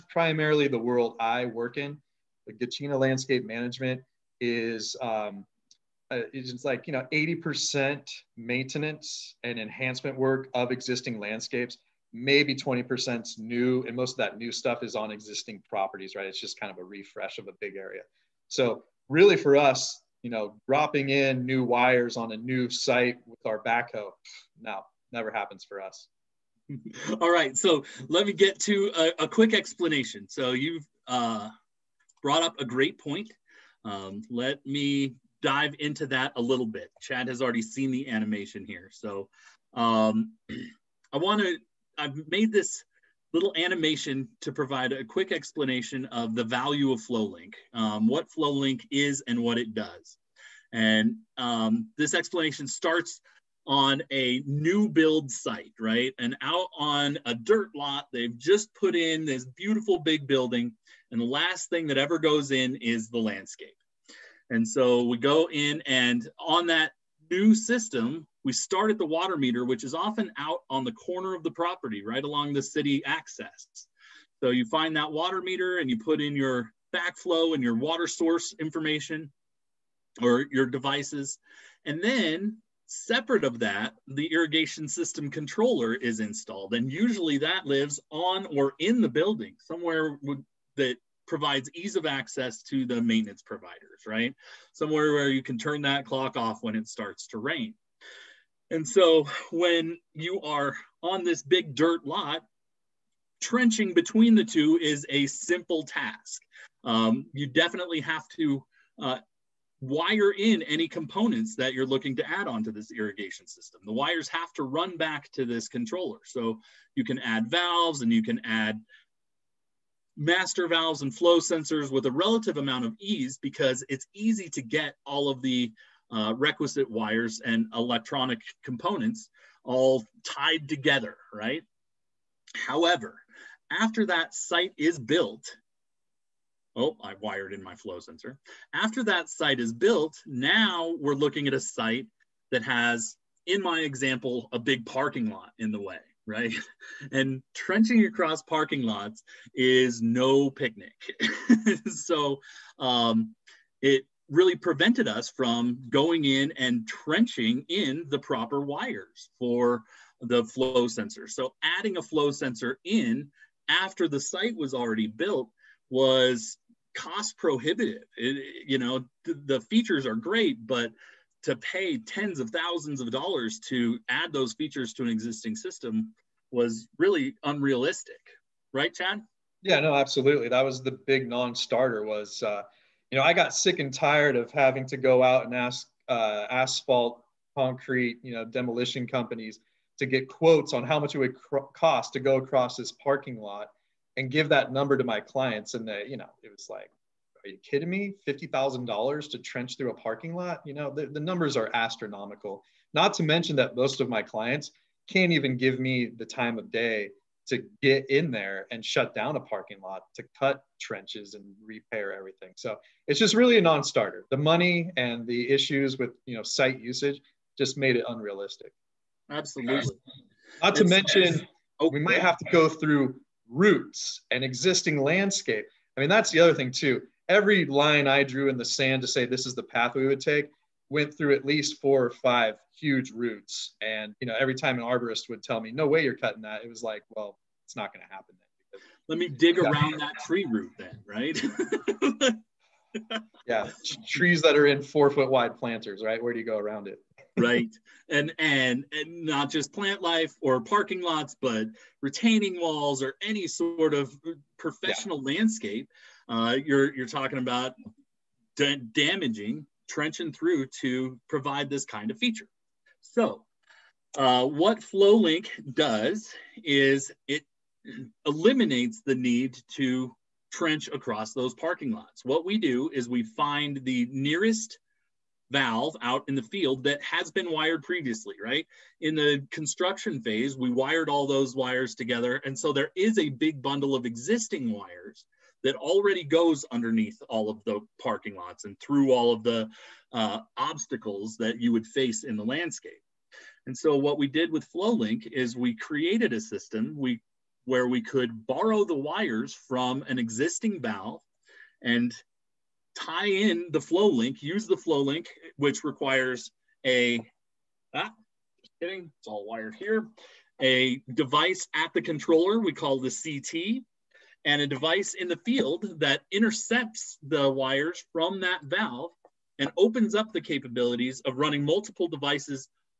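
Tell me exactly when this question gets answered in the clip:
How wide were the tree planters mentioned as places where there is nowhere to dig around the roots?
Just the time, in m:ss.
4:04.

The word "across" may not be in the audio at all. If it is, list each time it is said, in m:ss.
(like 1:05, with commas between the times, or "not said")
2:28, 3:12, 4:30.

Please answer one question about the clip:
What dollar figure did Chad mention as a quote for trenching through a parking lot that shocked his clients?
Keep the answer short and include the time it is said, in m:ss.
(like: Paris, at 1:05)
$50,000, at 3:18.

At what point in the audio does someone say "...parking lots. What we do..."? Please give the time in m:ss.
4:31.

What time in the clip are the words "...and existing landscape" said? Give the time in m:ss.
3:44.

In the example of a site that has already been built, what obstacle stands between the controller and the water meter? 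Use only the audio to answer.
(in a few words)
a big parking lot.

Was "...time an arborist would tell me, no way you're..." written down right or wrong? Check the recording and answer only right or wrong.
right.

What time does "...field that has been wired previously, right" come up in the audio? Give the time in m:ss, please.
4:36.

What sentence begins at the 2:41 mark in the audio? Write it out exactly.
So adding a flow sensor in after the site was already built was cost prohibitive.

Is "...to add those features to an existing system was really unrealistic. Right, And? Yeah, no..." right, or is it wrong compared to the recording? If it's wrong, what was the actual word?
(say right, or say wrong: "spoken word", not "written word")
wrong: "Chad", not "And".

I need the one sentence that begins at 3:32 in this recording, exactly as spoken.
So it's just really a non-starter.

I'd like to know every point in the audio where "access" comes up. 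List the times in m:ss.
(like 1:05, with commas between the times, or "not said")
1:13, 1:32.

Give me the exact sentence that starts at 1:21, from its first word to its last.
And then separate of that, the irrigation system controller is installed.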